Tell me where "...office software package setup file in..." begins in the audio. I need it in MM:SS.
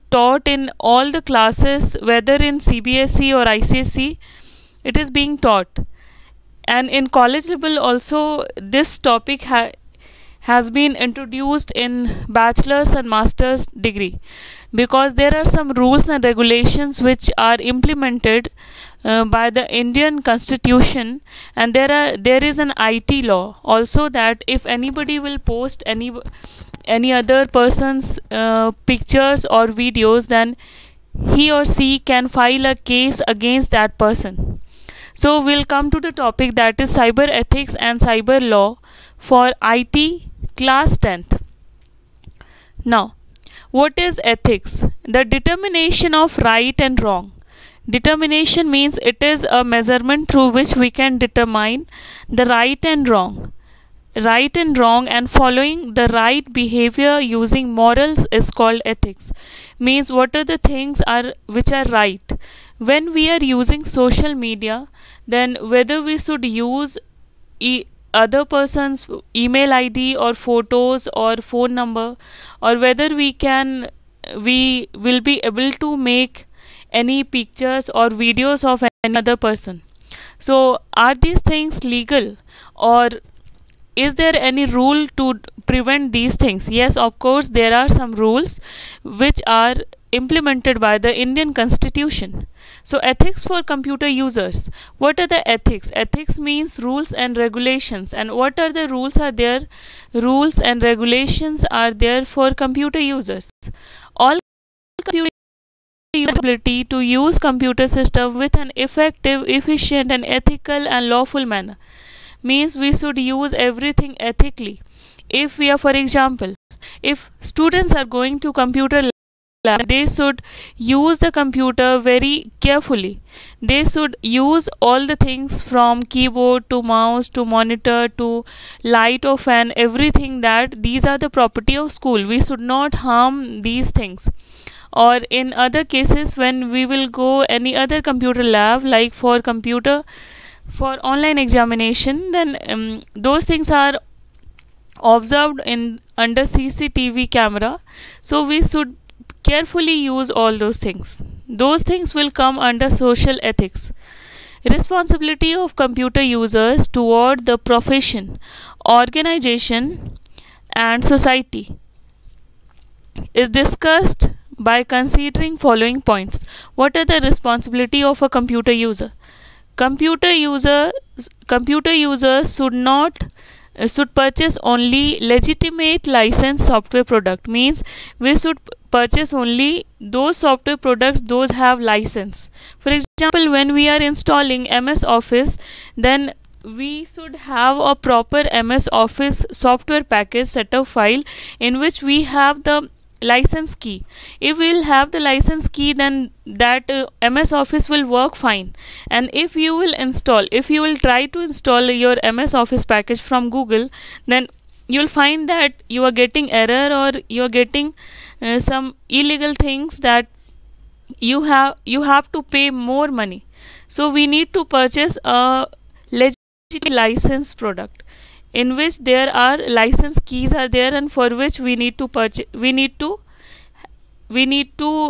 03:08.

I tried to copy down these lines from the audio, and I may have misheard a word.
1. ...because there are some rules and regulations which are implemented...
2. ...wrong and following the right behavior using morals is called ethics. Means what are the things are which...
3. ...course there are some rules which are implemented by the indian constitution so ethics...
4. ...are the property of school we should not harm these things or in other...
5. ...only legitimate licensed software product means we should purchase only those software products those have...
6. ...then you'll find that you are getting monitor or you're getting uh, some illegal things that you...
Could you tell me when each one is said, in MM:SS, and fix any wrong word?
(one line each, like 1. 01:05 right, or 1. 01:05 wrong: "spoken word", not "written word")
1. 00:14 right
2. 00:54 right
3. 01:27 right
4. 02:11 right
5. 02:54 right
6. 03:24 wrong: "error", not "monitor".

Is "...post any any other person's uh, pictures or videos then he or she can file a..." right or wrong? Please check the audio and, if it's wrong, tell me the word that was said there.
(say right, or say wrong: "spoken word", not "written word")
right.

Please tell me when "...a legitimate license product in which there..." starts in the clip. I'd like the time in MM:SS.
03:35.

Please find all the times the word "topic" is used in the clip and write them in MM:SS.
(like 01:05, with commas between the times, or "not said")
00:08, 00:36.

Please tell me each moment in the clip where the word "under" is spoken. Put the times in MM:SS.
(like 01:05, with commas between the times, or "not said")
02:26, 02:32.